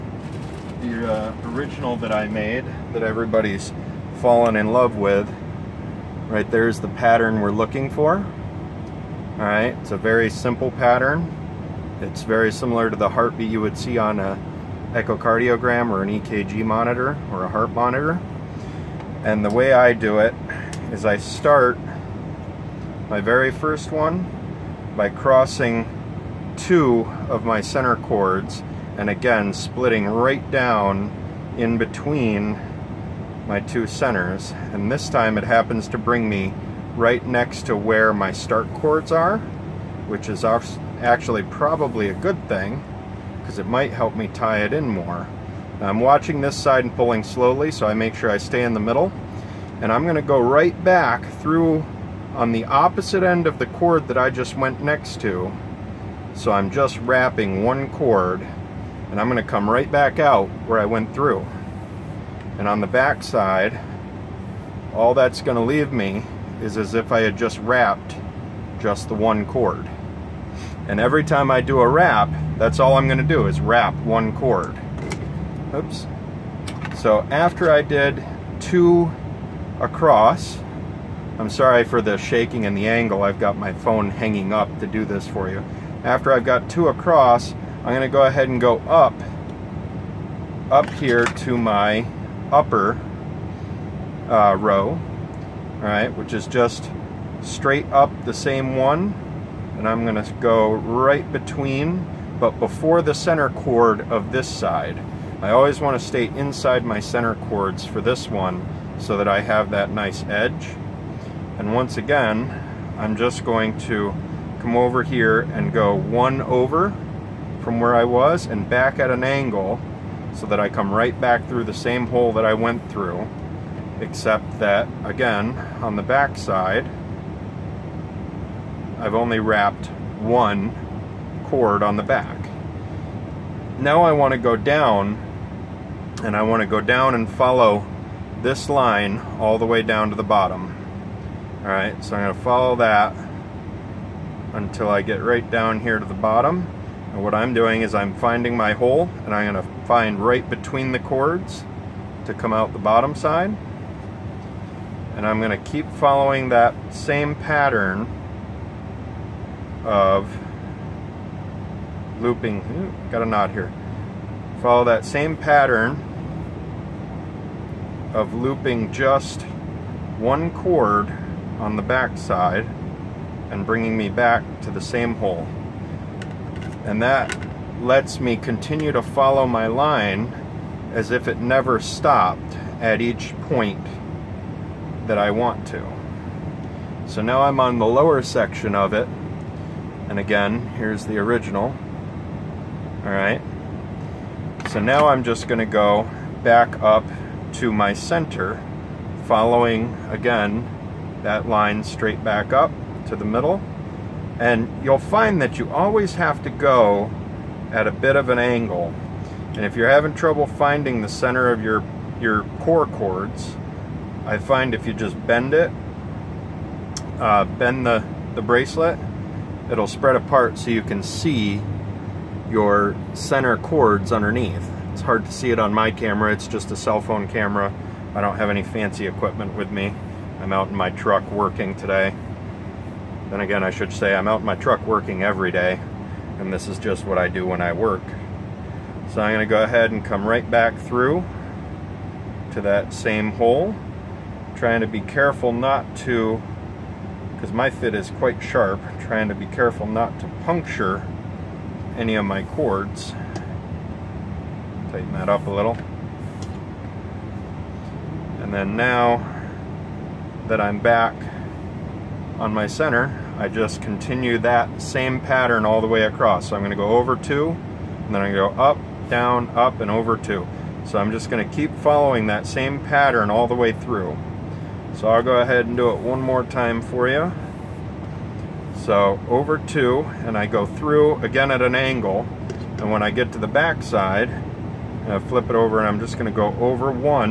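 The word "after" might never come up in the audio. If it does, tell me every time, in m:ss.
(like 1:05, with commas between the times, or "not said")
1:17, 1:26.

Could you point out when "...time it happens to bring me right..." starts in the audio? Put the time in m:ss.
0:35.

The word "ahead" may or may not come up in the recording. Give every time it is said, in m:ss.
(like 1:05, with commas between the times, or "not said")
1:28, 3:59, 4:35.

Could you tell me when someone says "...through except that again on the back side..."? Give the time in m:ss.
2:02.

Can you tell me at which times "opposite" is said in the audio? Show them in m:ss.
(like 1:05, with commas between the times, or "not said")
0:52.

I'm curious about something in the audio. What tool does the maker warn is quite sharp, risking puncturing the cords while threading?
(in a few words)
fid.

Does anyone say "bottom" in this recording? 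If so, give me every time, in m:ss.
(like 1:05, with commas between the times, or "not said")
2:20, 2:26, 2:32.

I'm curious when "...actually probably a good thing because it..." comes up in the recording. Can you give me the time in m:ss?
0:40.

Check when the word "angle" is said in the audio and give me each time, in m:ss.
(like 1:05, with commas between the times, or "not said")
1:22, 1:59, 3:28, 4:41.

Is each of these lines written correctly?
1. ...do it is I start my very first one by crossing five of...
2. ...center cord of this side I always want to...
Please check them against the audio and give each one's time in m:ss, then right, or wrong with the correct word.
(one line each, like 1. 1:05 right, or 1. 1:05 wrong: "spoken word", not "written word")
1. 0:19 wrong: "two", not "five"
2. 1:43 right.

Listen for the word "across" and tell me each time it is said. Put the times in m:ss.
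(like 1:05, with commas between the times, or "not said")
1:19, 1:26, 4:26.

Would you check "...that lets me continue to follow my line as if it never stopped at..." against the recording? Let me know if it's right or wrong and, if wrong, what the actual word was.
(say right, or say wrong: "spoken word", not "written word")
right.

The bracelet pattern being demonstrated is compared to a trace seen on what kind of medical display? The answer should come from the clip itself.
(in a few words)
EKG monitor.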